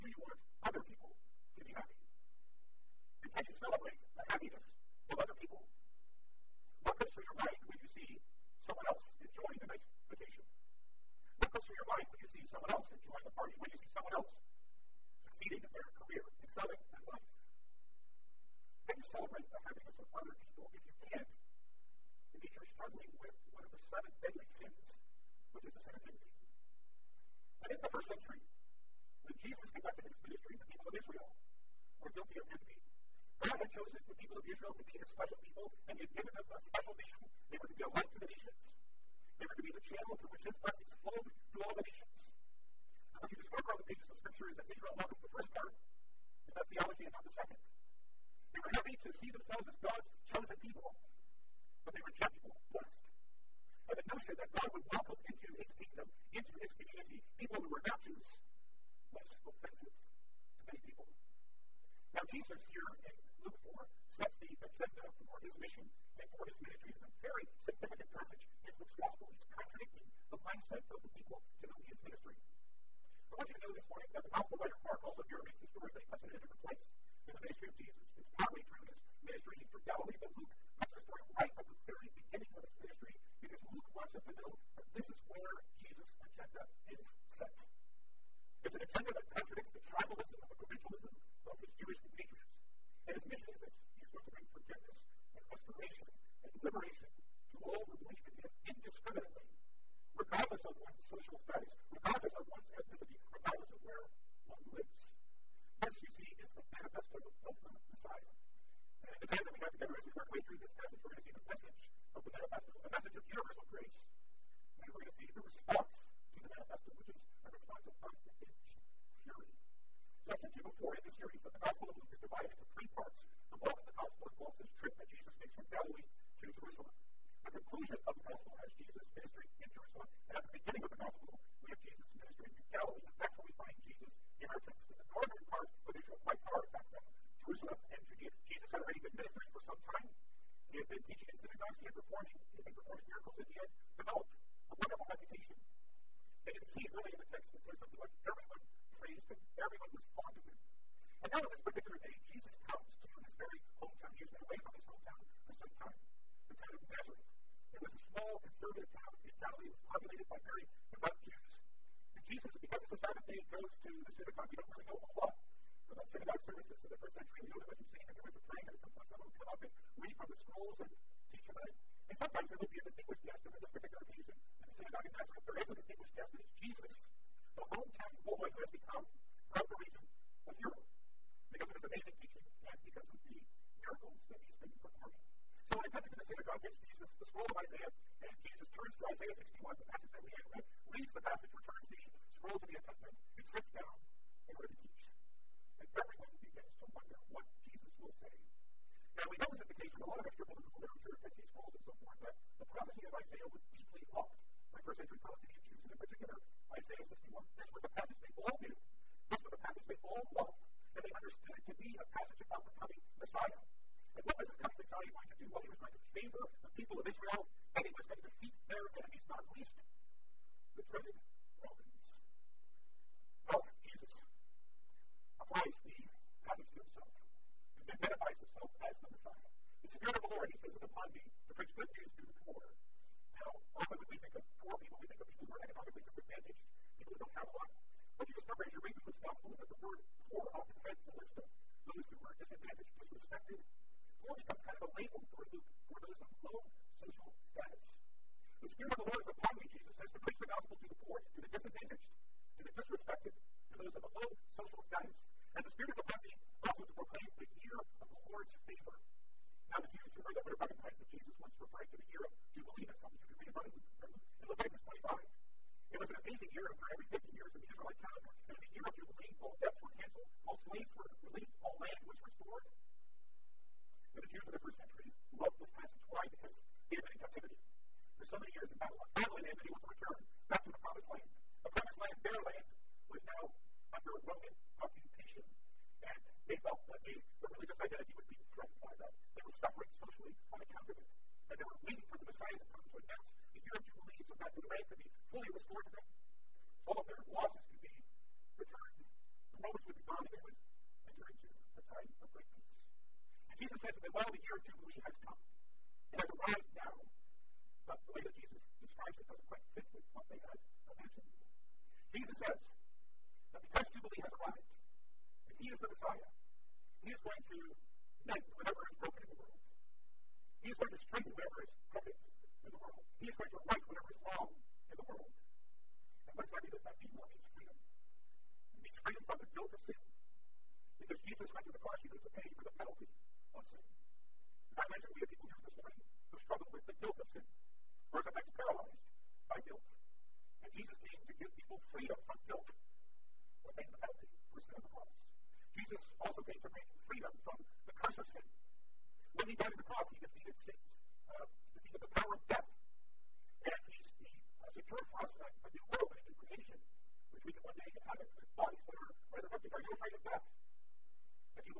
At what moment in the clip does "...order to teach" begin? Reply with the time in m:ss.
3:14.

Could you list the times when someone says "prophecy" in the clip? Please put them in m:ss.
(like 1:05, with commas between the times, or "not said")
3:22.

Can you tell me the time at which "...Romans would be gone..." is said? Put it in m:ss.
4:59.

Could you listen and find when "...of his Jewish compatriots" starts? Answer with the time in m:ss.
1:31.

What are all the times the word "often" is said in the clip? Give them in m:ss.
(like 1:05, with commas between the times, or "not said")
3:53, 4:00.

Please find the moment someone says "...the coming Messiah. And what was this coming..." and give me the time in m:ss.
3:32.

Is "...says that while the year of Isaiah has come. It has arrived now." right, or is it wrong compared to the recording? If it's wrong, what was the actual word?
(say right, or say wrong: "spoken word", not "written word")
wrong: "Jubilee", not "Isaiah".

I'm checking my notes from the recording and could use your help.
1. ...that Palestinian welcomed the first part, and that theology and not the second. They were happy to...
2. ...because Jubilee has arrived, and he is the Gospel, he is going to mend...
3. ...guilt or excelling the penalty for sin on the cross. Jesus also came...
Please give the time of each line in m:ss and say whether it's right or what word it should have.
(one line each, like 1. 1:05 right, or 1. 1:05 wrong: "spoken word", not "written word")
1. 0:44 wrong: "Israel", not "Palestinian"
2. 5:13 wrong: "Messiah", not "Gospel"
3. 5:42 wrong: "paying", not "excelling".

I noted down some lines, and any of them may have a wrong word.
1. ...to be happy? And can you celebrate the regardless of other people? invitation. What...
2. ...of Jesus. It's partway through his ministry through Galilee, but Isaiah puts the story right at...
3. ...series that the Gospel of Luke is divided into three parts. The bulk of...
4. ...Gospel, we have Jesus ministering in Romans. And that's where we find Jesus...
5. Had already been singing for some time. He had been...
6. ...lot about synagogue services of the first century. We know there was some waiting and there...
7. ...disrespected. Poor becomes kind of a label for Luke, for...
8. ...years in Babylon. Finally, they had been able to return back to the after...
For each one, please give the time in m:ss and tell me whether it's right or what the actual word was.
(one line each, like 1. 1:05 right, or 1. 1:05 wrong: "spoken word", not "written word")
1. 0:01 wrong: "happiness", not "regardless"
2. 1:17 wrong: "Luke", not "Isaiah"
3. 2:01 right
4. 2:10 wrong: "Galilee", not "Romans"
5. 2:18 wrong: "ministering", not "singing"
6. 2:45 wrong: "singing", not "waiting"
7. 4:03 right
8. 4:38 right.